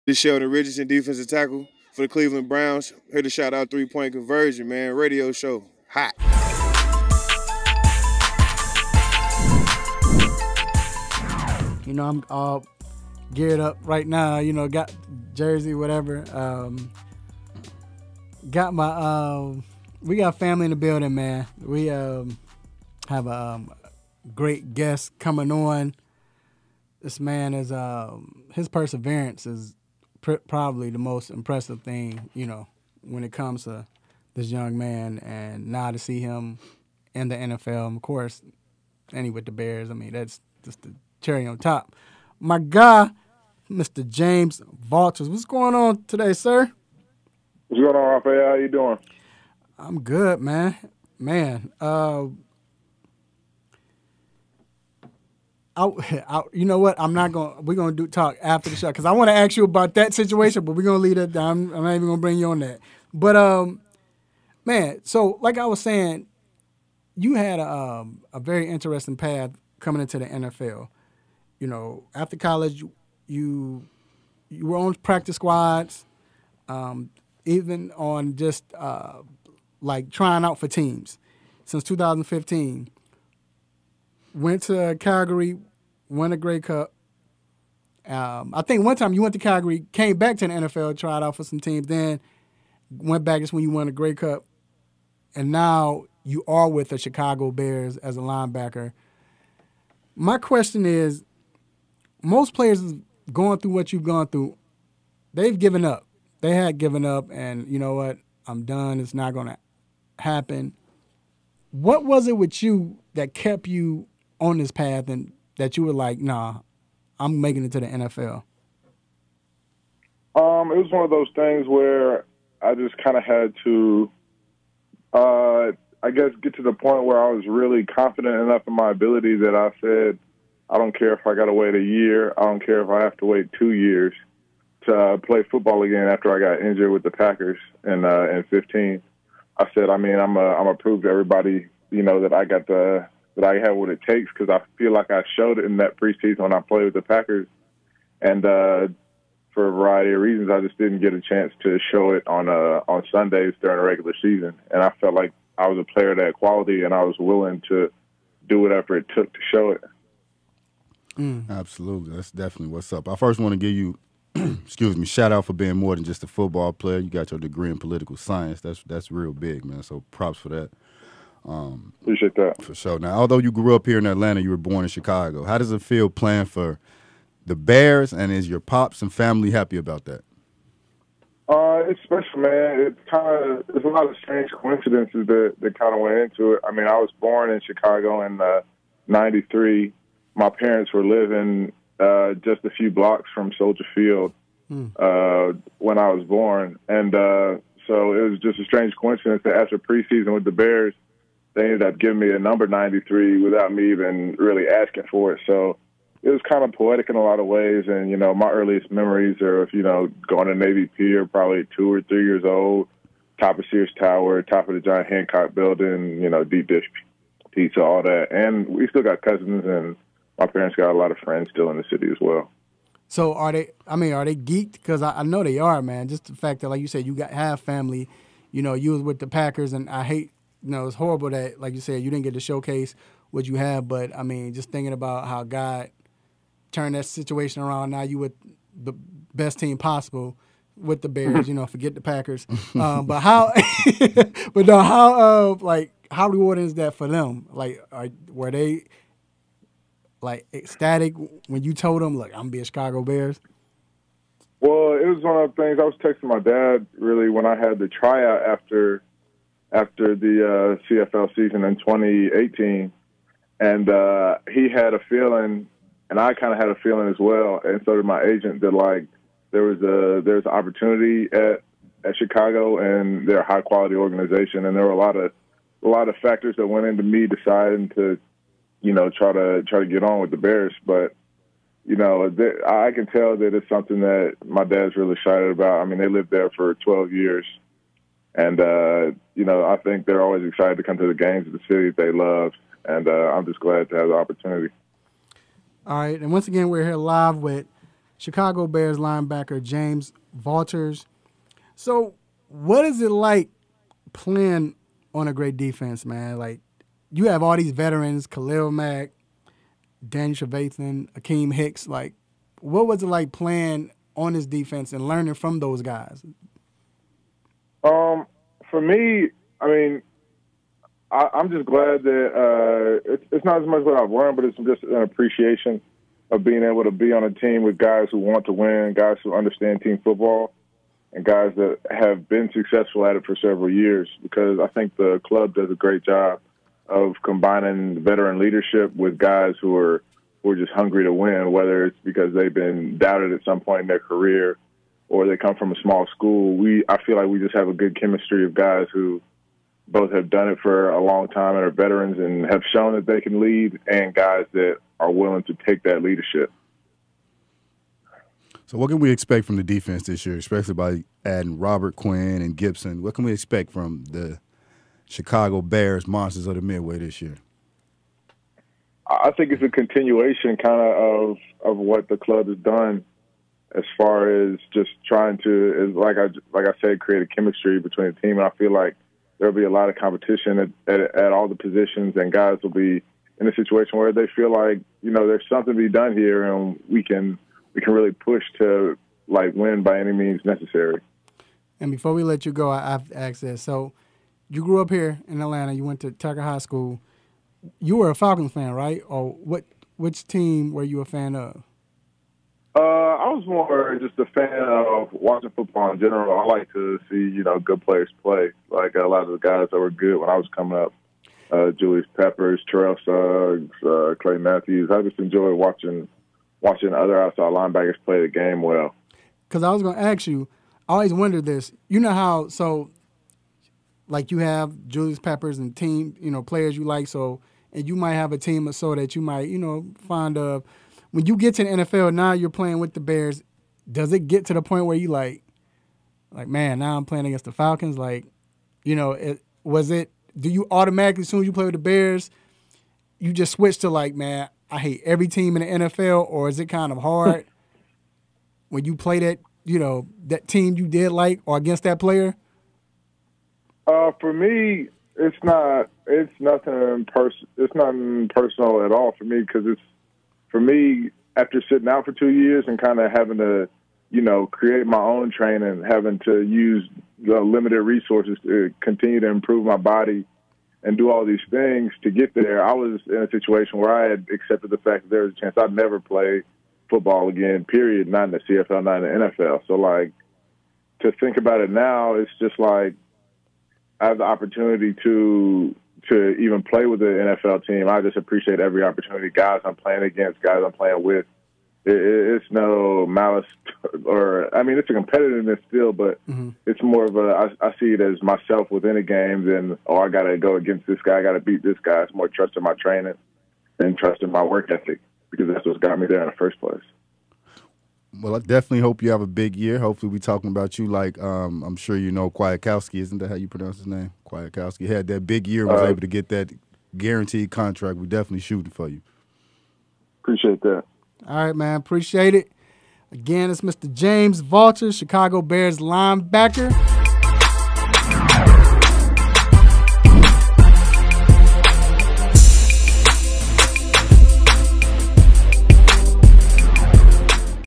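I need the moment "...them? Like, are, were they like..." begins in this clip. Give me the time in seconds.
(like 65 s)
247 s.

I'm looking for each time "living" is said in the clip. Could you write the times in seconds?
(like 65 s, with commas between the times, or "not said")
191 s.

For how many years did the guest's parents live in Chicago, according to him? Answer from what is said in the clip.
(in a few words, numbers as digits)
12.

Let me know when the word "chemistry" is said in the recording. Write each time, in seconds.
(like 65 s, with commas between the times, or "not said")
347 s, 377 s.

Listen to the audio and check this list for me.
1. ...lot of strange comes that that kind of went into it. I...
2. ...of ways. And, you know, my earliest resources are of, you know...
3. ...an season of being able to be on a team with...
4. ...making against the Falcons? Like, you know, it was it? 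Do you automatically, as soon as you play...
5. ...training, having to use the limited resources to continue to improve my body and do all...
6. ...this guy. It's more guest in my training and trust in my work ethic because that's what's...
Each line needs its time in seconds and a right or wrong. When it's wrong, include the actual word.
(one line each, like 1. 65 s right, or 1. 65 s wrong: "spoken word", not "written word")
1. 183 s wrong: "coincidences", not "comes"
2. 207 s wrong: "memories", not "resources"
3. 324 s wrong: "appreciation", not "season"
4. 437 s wrong: "playing", not "making"
5. 465 s right
6. 501 s wrong: "trust", not "guest".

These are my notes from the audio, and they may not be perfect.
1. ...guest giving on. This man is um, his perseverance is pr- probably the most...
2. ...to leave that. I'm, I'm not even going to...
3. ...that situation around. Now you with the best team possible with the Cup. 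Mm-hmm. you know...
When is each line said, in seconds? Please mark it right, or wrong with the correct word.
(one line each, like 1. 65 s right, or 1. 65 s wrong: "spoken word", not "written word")
1. 24 s wrong: "coming", not "giving"
2. 61 s right
3. 236 s wrong: "Bears", not "Cup".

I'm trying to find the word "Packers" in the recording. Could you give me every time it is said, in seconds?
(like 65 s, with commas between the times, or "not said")
137 s, 147 s, 229 s, 242 s.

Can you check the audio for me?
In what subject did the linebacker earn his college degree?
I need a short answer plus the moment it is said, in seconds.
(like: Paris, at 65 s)
Political science, at 167 s.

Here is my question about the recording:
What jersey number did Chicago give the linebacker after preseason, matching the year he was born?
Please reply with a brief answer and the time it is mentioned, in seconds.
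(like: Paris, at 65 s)
93, at 202 s.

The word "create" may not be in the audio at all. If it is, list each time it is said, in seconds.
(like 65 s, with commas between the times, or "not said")
376 s, 464 s.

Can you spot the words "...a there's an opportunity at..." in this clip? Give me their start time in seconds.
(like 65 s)
269 s.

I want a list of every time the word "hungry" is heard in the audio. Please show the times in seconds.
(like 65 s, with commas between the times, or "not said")
340 s.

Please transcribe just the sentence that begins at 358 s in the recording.
So, what can we expect from the defense this year, especially by adding Robert Quinn and Gibson?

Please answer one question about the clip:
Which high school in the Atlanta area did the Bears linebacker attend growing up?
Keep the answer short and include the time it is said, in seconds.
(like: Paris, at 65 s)
Tucker High School, at 396 s.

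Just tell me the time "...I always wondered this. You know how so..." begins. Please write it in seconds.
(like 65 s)
420 s.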